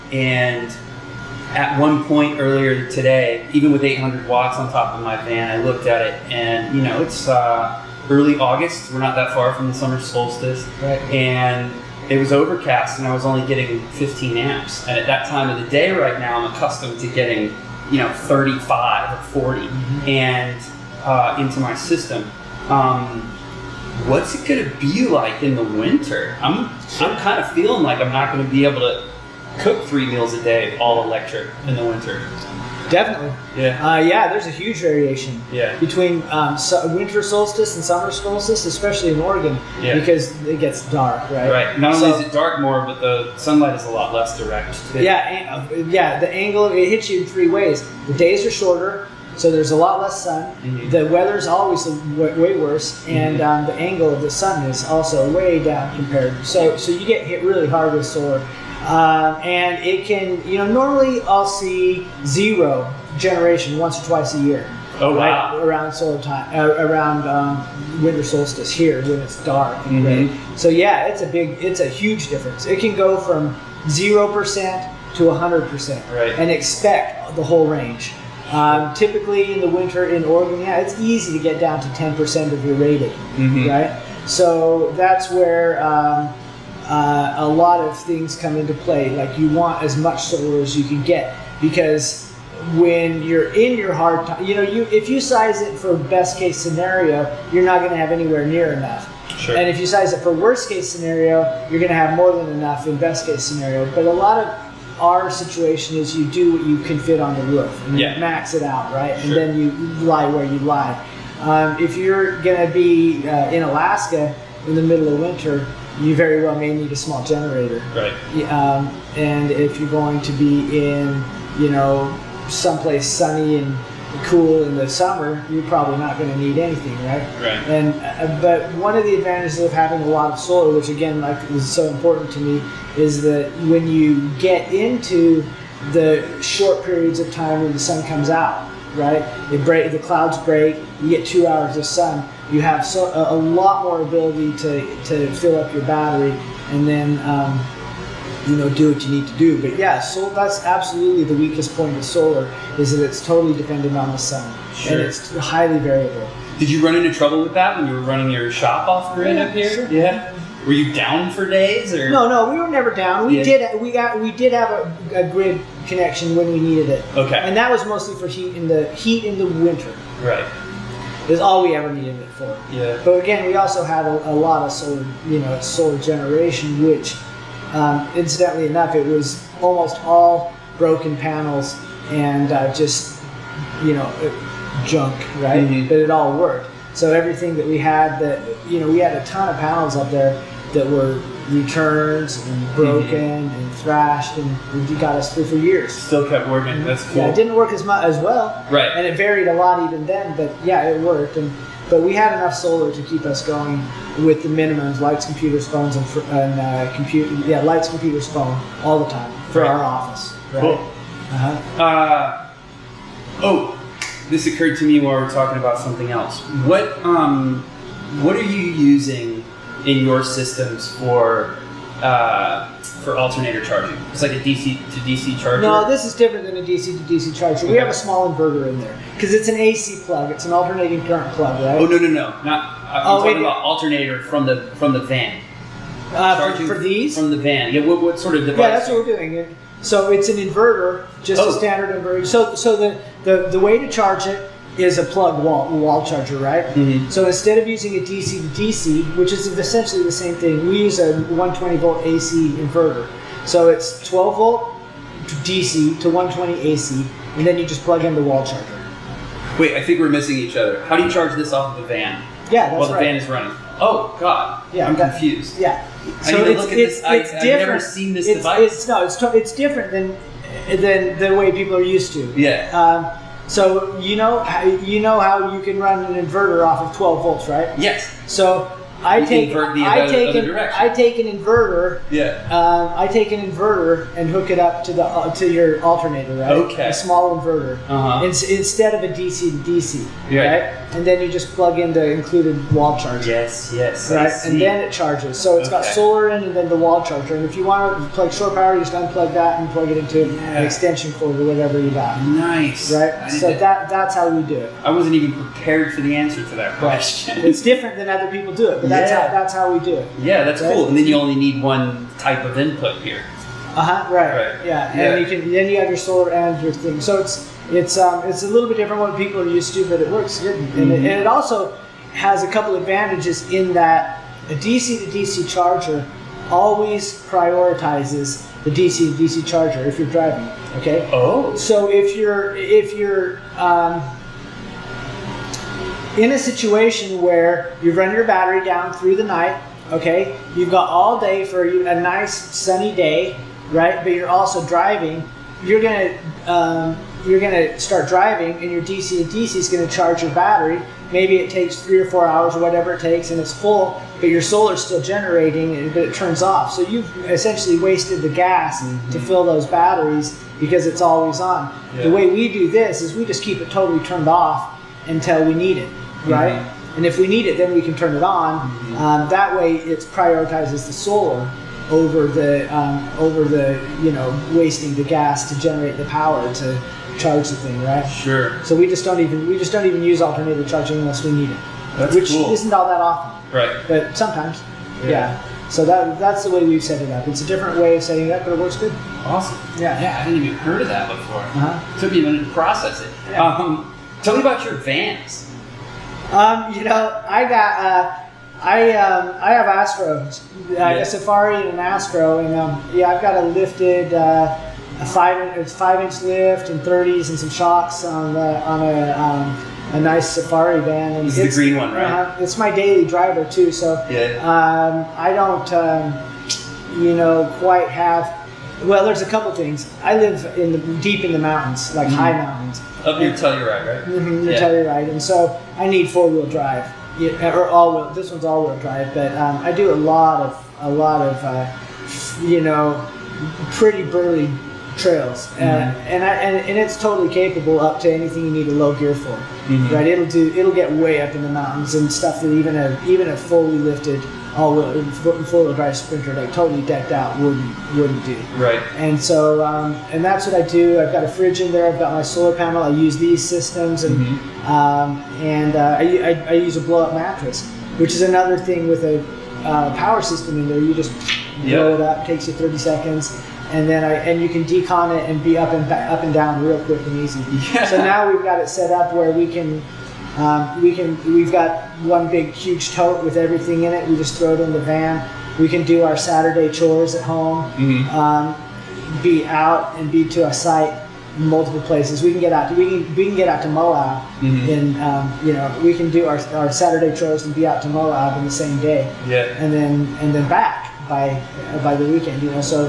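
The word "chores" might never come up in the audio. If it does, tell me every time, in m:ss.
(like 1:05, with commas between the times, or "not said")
7:56, 8:07.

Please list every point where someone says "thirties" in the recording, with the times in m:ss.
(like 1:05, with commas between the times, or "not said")
6:46.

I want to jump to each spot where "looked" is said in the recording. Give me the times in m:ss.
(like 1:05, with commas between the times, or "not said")
0:05.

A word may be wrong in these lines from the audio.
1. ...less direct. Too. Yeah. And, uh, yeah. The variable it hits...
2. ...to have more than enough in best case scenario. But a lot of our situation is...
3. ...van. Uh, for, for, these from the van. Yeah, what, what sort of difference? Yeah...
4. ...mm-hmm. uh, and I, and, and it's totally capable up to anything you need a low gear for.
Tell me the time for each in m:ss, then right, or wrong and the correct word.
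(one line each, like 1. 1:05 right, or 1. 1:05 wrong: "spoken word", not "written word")
1. 0:44 wrong: "angle", not "variable"
2. 1:41 right
3. 3:55 wrong: "device", not "difference"
4. 7:15 right.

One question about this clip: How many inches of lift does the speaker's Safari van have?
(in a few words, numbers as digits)
5 inches.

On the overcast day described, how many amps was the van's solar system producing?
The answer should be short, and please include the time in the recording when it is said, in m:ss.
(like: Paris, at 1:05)
15 amps, at 0:13.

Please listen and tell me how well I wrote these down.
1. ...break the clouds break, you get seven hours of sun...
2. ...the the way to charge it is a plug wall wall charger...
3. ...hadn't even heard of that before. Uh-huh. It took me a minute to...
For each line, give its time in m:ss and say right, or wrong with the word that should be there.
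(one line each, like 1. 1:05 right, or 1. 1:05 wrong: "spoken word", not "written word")
1. 2:19 wrong: "two", not "seven"
2. 4:03 right
3. 6:30 right.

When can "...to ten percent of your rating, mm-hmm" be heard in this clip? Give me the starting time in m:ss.
1:21.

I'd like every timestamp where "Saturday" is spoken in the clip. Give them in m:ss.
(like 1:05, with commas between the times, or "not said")
7:56, 8:06.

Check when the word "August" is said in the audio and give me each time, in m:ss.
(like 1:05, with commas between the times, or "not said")
0:08.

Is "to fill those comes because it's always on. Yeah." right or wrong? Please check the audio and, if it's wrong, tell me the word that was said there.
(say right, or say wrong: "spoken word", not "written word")
wrong: "batteries", not "comes".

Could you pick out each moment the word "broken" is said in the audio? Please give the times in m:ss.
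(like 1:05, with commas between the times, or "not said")
3:00, 3:12.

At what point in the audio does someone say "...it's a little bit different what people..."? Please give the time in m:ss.
5:18.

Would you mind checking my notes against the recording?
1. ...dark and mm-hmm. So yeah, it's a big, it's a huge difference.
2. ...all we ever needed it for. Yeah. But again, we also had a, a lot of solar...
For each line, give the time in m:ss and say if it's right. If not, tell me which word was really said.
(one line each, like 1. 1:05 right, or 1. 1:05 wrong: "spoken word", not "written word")
1. 1:09 right
2. 2:51 right.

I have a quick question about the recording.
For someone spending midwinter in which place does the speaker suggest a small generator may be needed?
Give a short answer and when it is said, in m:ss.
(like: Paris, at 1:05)
Alaska, at 1:53.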